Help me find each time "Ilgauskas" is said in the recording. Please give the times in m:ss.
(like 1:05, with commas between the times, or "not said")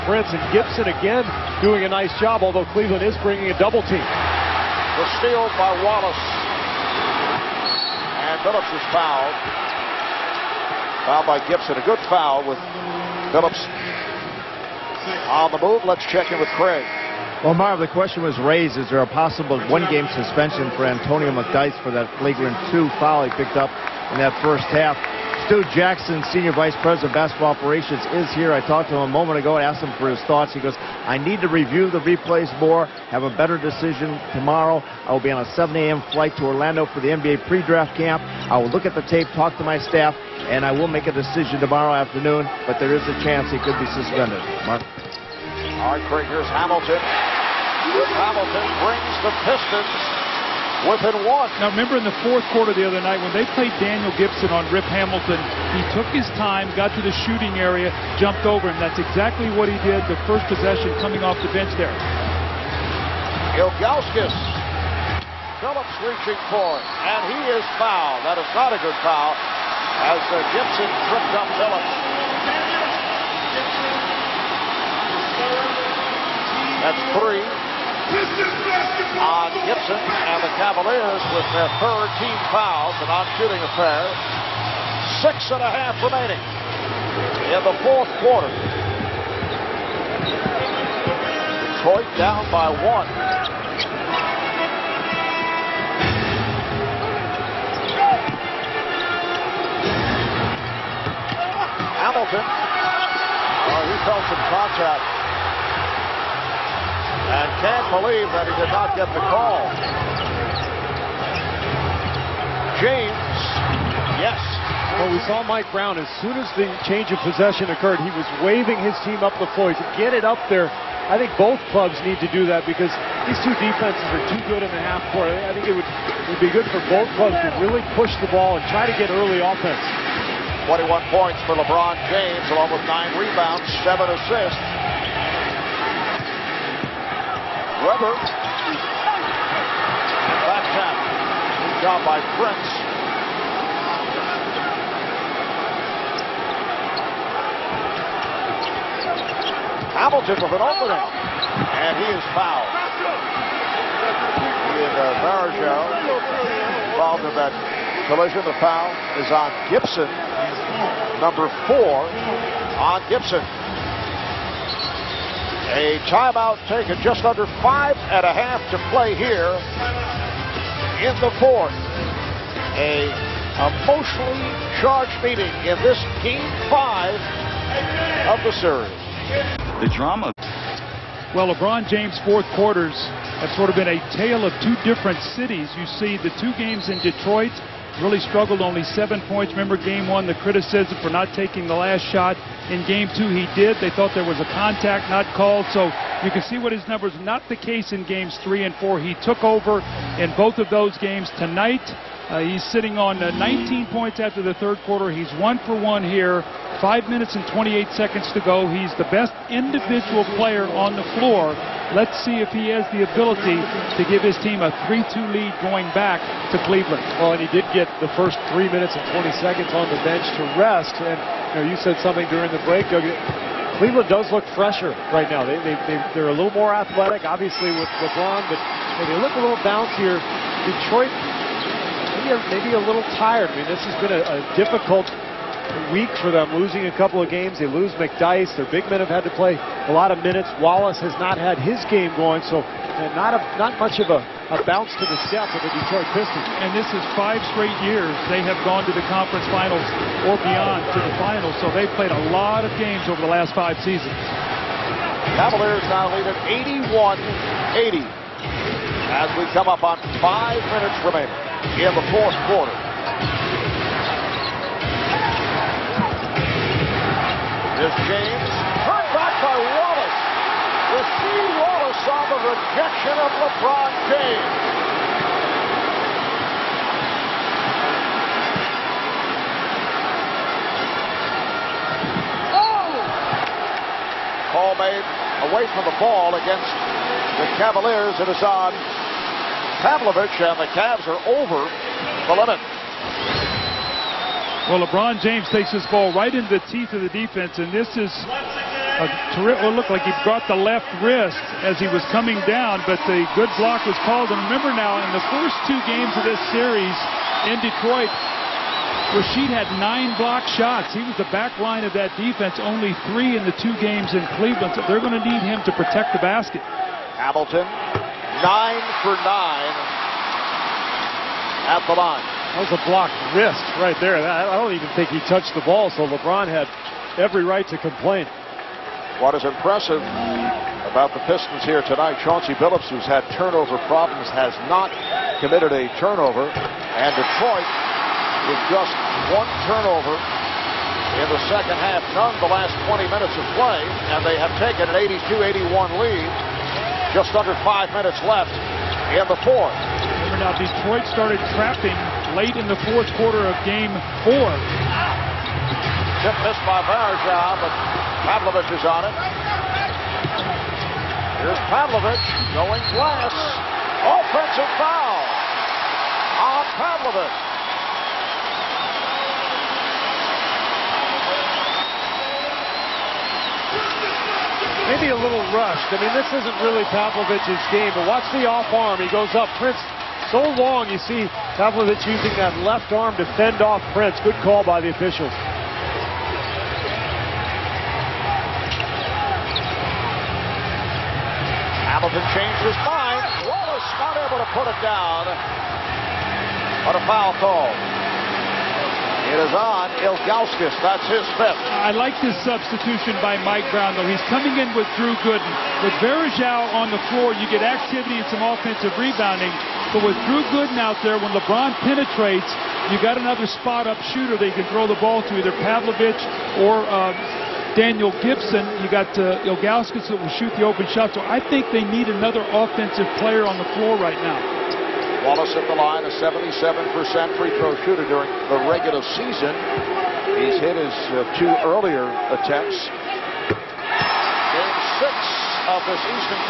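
1:03, 6:40, 6:59.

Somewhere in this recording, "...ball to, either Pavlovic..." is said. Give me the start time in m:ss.
6:55.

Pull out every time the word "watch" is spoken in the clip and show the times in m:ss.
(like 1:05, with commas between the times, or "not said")
6:18.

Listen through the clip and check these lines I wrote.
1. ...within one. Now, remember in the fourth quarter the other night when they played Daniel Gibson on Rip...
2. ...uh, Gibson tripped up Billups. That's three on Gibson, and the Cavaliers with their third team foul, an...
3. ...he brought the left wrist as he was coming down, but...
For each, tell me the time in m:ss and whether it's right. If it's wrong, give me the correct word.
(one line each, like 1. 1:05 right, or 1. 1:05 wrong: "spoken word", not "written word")
1. 0:50 right
2. 1:10 right
3. 5:00 right.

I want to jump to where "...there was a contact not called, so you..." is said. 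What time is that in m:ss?
3:14.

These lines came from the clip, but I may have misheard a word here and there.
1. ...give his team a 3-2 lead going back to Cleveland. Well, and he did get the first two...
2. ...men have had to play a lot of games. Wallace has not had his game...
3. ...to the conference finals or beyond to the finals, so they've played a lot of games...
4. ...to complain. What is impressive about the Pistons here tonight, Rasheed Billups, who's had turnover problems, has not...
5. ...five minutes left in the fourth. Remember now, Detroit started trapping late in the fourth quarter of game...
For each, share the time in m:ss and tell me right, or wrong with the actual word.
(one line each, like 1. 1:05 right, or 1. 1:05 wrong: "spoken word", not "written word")
1. 3:34 wrong: "three", not "two"
2. 3:58 wrong: "minutes", not "games"
3. 4:08 right
4. 5:27 wrong: "Chauncey", not "Rasheed"
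5. 5:47 right.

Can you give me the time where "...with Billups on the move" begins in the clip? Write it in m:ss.
0:12.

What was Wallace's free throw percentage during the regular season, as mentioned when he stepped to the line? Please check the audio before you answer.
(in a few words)
77%.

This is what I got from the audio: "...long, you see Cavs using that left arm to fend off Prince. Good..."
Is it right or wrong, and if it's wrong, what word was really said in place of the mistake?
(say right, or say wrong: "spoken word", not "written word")
wrong: "Pavlovic", not "Cavs".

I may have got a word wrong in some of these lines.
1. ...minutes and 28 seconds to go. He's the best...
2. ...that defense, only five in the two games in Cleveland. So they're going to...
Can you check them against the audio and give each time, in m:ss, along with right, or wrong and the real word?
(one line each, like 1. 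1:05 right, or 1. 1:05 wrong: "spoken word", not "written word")
1. 3:27 right
2. 5:11 wrong: "three", not "five".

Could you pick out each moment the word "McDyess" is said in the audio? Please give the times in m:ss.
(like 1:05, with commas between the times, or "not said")
0:21, 3:57.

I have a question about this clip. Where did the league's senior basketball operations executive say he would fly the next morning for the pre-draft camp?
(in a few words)
Orlando.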